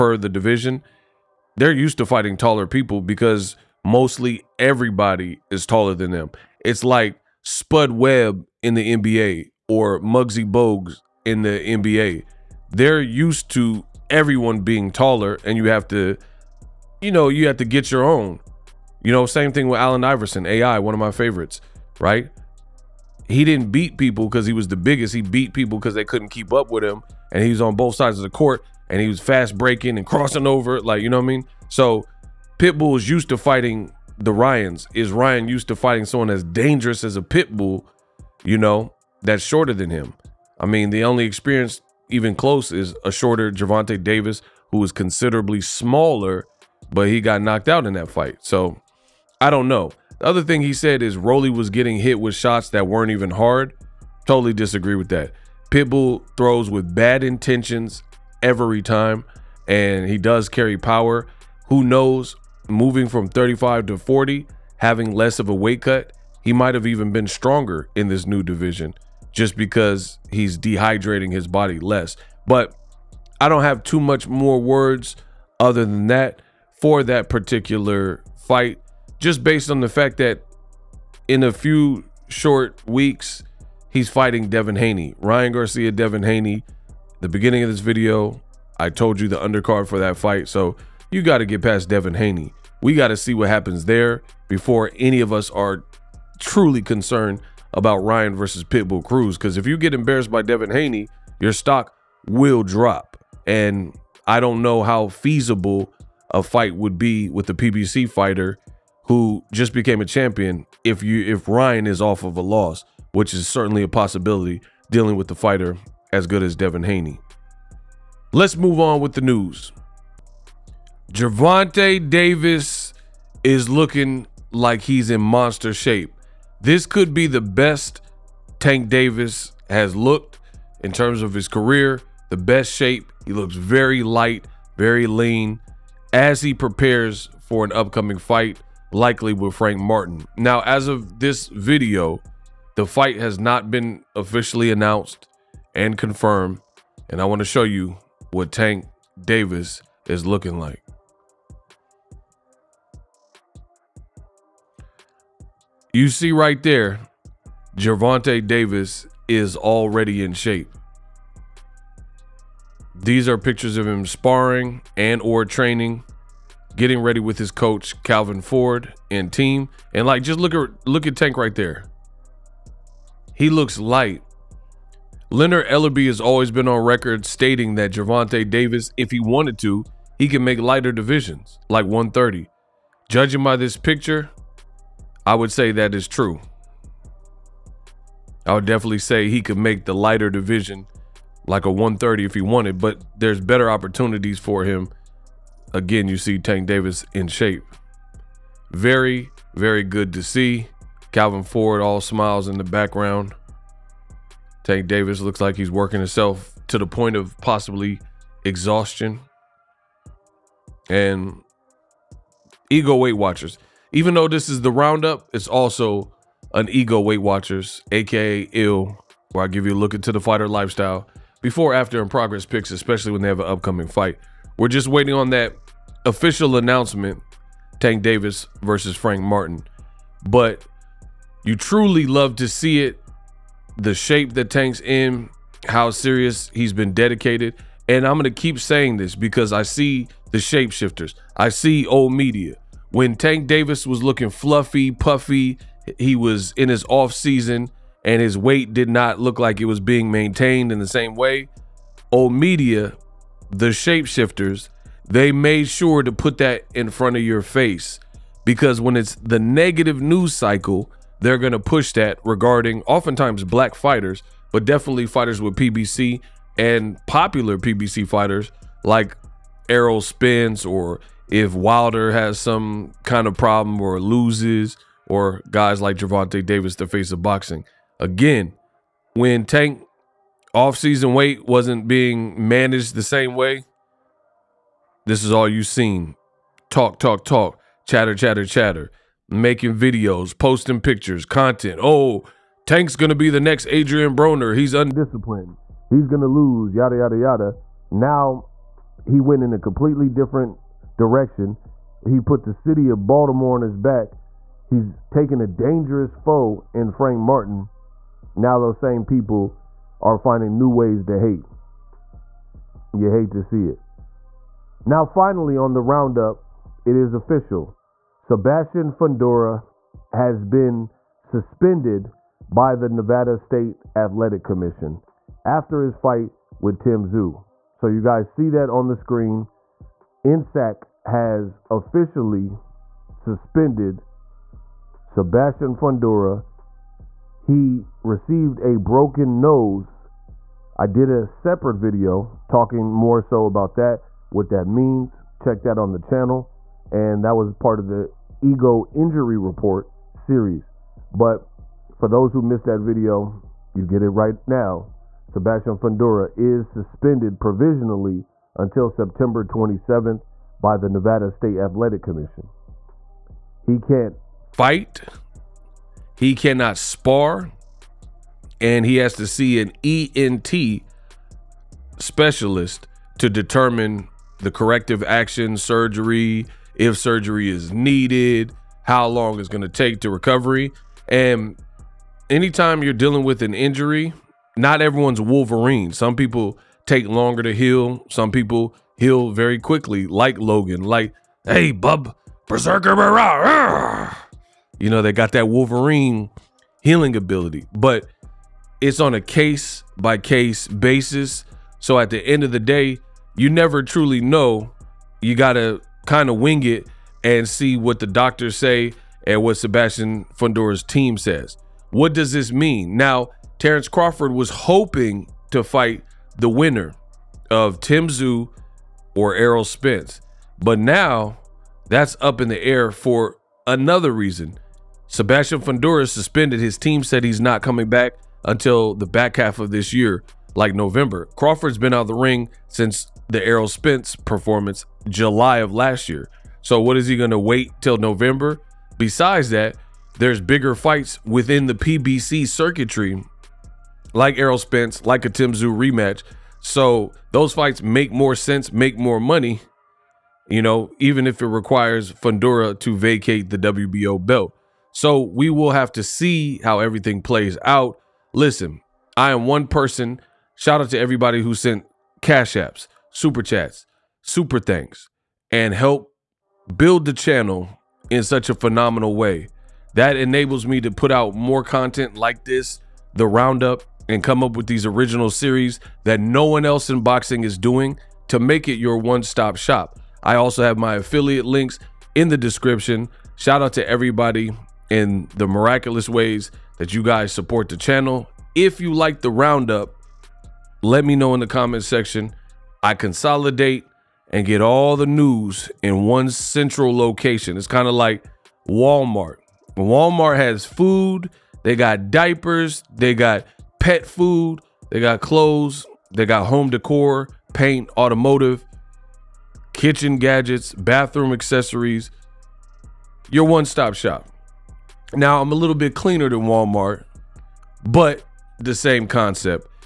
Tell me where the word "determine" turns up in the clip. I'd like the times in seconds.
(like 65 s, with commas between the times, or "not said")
373 s.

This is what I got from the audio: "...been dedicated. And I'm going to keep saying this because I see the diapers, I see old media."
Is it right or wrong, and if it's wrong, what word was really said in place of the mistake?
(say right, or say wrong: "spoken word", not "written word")
wrong: "shapeshifters", not "diapers".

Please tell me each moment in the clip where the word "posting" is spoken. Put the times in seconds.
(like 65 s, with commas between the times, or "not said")
290 s.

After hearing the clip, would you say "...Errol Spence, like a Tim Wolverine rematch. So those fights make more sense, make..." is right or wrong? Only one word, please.
wrong.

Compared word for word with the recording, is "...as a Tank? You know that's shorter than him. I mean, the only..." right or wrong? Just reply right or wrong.
wrong.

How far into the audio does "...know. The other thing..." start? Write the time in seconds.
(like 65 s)
49 s.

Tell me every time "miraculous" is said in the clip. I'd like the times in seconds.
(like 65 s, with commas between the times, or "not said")
485 s.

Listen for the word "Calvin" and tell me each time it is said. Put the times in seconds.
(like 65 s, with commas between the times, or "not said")
168 s, 201 s.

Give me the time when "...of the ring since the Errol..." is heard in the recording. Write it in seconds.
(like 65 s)
432 s.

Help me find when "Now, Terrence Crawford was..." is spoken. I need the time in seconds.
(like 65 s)
412 s.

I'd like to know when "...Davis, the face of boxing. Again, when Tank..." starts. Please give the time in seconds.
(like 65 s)
276 s.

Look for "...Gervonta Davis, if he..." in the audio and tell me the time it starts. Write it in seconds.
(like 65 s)
177 s.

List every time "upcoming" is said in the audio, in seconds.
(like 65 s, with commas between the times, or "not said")
137 s, 223 s.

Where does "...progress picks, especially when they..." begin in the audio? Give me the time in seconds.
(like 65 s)
222 s.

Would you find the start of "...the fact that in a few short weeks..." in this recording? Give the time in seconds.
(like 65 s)
79 s.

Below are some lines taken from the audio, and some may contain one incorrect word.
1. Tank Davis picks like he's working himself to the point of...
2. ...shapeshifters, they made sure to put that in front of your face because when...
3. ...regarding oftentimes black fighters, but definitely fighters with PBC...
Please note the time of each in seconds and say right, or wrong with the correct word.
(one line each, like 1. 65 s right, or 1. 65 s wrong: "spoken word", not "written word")
1. 204 s wrong: "looks", not "picks"
2. 253 s right
3. 262 s right.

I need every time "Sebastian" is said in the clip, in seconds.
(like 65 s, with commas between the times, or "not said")
318 s, 335 s, 355 s, 409 s, 425 s.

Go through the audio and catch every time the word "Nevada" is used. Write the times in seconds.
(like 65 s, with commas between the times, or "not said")
322 s, 360 s.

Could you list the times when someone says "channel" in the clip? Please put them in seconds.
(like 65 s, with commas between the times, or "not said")
345 s, 467 s, 487 s.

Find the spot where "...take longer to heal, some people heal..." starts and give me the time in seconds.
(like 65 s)
386 s.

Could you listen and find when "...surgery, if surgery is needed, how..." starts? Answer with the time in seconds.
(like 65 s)
375 s.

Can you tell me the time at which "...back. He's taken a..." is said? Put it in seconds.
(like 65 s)
303 s.